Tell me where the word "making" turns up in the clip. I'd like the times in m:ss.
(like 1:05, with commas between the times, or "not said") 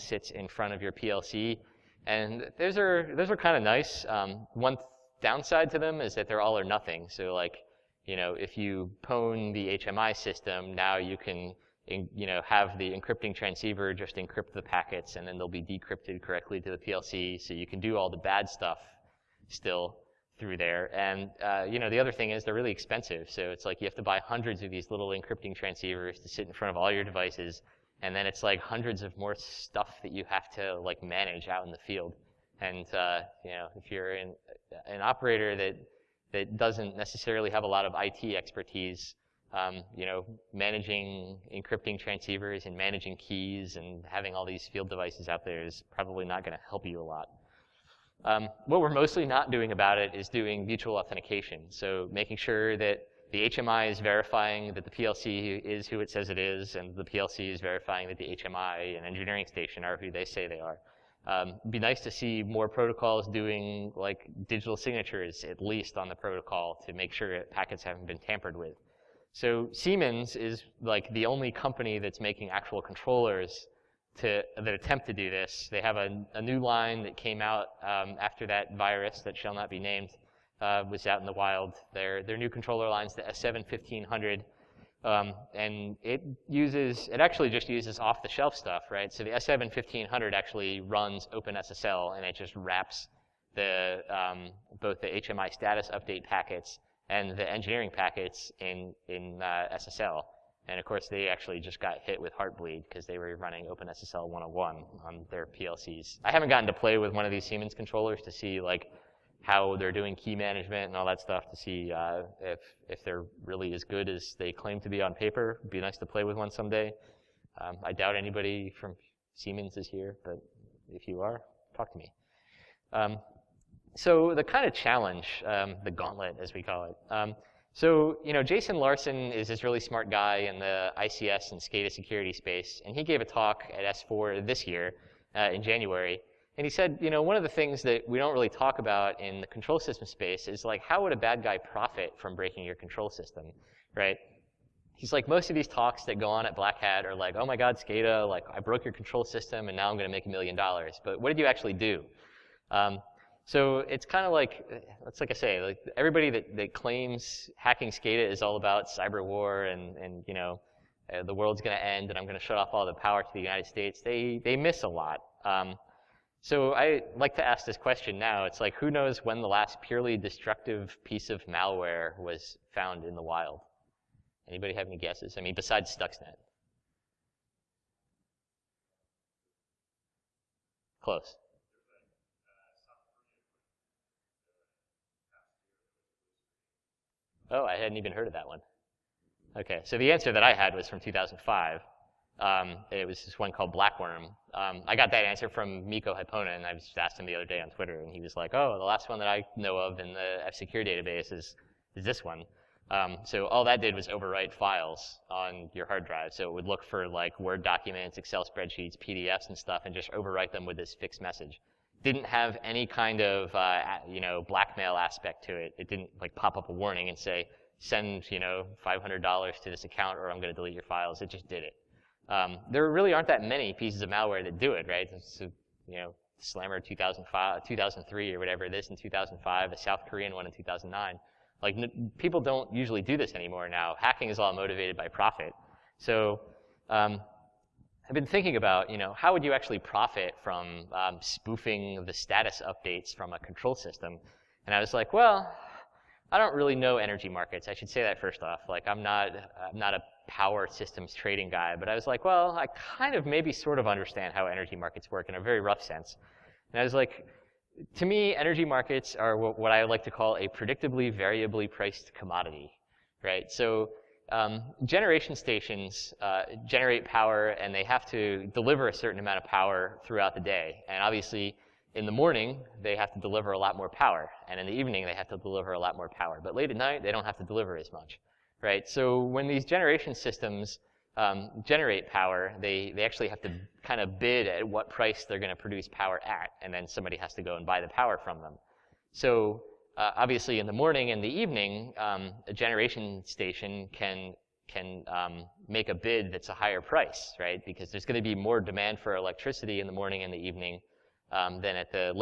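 0:52, 1:12.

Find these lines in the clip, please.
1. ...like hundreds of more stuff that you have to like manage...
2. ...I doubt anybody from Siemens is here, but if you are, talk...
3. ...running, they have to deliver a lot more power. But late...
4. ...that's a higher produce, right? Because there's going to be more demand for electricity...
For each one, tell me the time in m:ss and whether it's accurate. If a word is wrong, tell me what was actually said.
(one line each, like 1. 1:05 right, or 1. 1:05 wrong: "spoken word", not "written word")
1. 0:28 right
2. 1:57 right
3. 4:34 wrong: "evening", not "running"
4. 4:56 wrong: "price", not "produce".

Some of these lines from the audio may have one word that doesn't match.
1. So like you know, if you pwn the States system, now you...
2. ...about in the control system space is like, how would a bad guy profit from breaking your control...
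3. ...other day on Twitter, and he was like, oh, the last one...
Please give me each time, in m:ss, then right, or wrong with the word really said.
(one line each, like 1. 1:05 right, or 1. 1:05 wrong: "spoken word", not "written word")
1. 0:07 wrong: "HMI", not "States"
2. 2:18 right
3. 3:17 right.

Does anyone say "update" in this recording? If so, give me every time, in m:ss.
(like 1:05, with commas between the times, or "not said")
1:35, 4:02.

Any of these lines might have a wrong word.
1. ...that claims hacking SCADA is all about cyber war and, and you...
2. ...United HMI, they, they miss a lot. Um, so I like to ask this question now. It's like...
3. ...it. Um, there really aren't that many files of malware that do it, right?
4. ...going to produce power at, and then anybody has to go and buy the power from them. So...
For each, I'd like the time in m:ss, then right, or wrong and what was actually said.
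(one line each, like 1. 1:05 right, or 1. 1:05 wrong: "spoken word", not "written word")
1. 2:36 right
2. 2:43 wrong: "States", not "HMI"
3. 3:41 wrong: "pieces", not "files"
4. 4:45 wrong: "somebody", not "anybody".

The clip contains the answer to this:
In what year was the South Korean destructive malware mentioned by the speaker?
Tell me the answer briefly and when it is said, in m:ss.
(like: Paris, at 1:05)
2009, at 3:50.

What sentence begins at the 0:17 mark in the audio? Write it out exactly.
So you can do all the bad stuff still through there.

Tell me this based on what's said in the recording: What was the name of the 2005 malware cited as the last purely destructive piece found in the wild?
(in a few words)
Blackworm.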